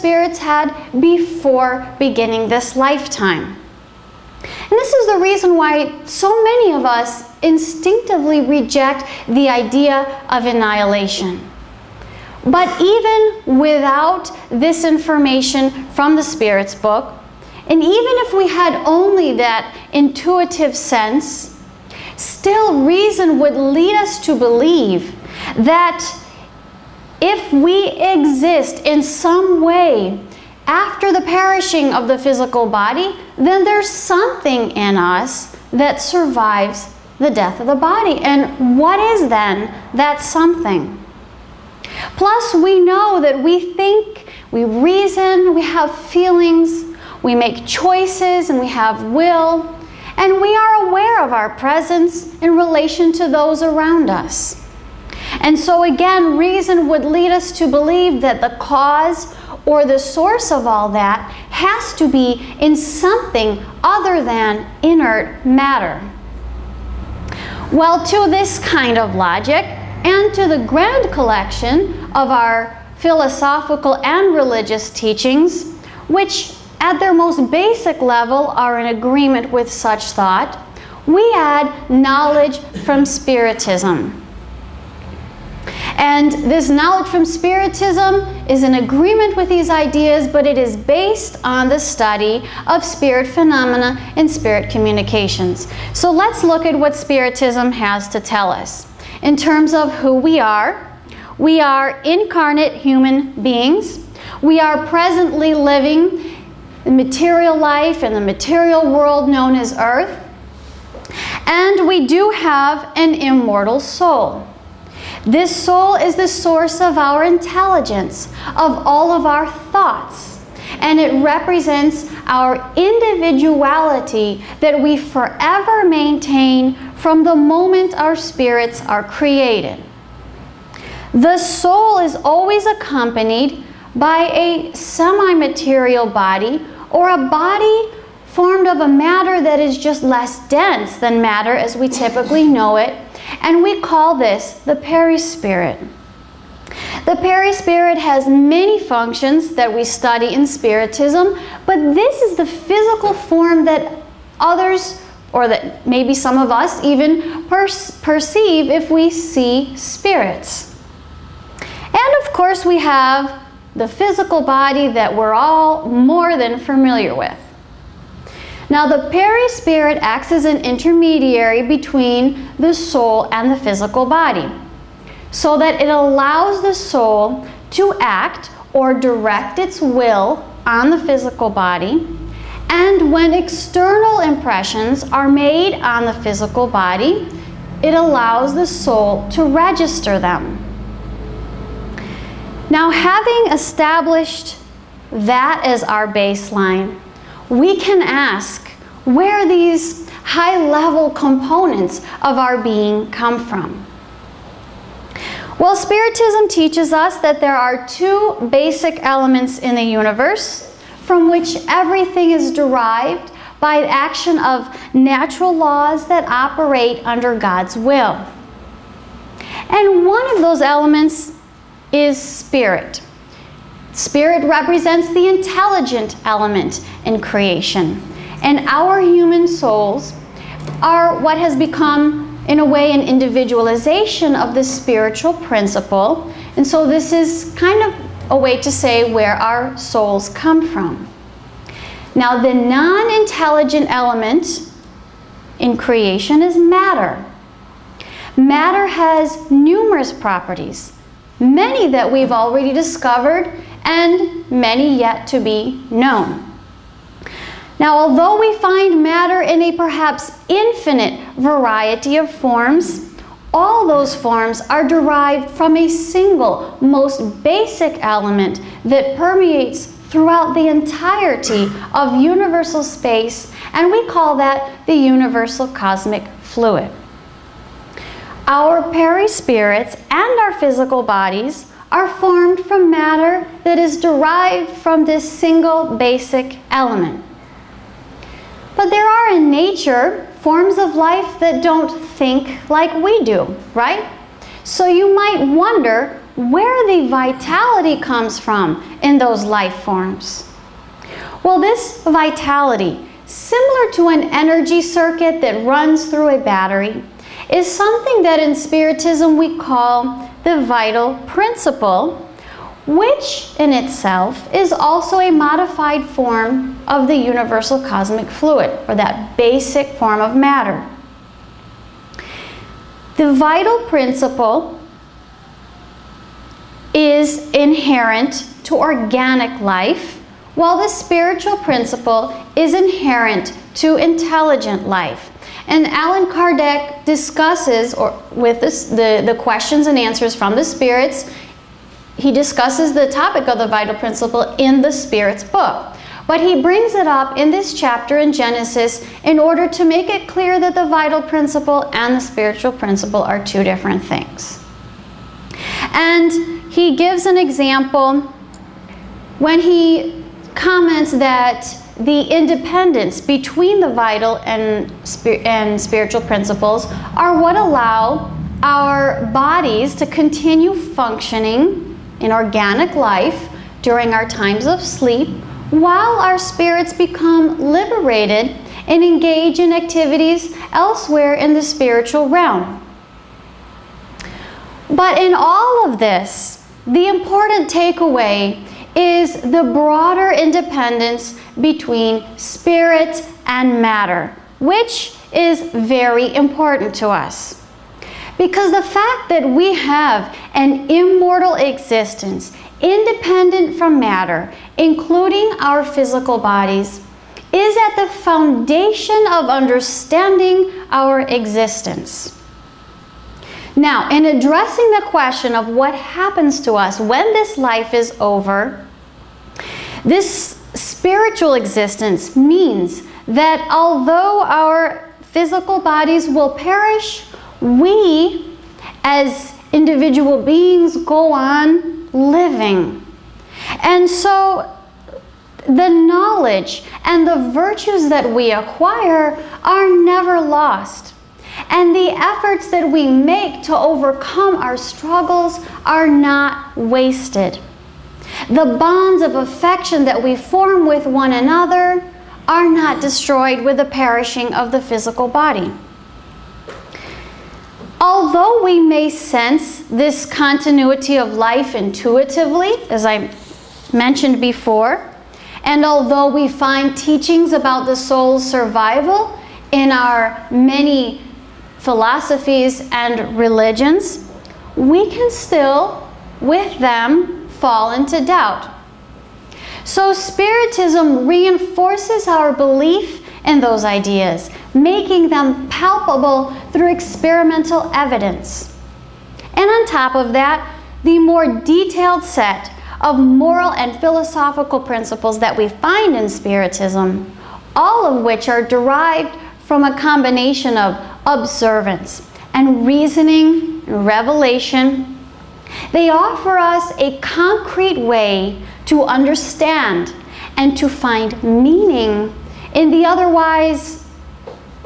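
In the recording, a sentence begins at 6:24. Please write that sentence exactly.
But in all of this, the important takeaway is the broader independence between spirit and matter, which is very important to us.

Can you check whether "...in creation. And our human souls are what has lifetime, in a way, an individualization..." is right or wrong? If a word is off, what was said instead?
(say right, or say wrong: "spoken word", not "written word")
wrong: "become", not "lifetime".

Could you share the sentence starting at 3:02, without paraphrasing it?
And when external impressions are made on the physical body, it allows the soul to register them.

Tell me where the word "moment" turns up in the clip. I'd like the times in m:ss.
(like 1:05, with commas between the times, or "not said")
2:07.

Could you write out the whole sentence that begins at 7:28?
The bonds of affection that we form with one another are not destroyed with the perishing of the physical body.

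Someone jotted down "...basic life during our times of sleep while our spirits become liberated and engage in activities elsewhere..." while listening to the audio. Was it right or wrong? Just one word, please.
wrong.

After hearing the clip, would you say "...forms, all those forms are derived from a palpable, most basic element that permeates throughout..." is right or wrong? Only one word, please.
wrong.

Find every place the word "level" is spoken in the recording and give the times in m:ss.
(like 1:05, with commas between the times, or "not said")
1:18, 3:20.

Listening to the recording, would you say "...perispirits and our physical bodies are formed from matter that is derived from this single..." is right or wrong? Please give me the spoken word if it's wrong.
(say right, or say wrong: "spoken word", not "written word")
right.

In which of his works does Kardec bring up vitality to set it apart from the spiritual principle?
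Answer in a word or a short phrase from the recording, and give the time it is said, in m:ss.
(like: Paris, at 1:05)
Genesis, at 5:48.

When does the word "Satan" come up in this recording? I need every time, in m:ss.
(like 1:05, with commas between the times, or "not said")
not said.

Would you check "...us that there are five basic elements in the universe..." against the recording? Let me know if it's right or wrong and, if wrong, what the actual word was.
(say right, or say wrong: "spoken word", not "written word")
wrong: "two", not "five".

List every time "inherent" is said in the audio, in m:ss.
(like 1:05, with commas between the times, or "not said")
5:27, 5:32.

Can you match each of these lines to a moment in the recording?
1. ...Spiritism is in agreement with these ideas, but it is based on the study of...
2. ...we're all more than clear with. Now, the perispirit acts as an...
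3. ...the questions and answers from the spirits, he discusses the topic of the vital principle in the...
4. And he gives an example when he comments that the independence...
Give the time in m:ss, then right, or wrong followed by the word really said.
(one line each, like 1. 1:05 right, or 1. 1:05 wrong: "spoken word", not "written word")
1. 1:27 right
2. 2:45 wrong: "familiar", not "clear"
3. 5:39 right
4. 5:55 right.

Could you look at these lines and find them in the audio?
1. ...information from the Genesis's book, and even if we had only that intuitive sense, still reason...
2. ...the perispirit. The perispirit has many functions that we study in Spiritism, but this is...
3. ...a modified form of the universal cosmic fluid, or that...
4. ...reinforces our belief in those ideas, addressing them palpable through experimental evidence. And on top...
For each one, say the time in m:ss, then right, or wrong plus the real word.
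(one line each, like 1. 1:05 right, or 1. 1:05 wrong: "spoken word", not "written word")
1. 0:14 wrong: "Spirit", not "Genesis"
2. 2:24 right
3. 5:15 right
4. 8:01 wrong: "making", not "addressing".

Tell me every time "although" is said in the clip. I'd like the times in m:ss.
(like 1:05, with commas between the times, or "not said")
4:17, 7:03, 7:37, 7:45.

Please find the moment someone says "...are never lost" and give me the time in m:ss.
7:19.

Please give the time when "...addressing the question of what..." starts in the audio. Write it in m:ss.
6:54.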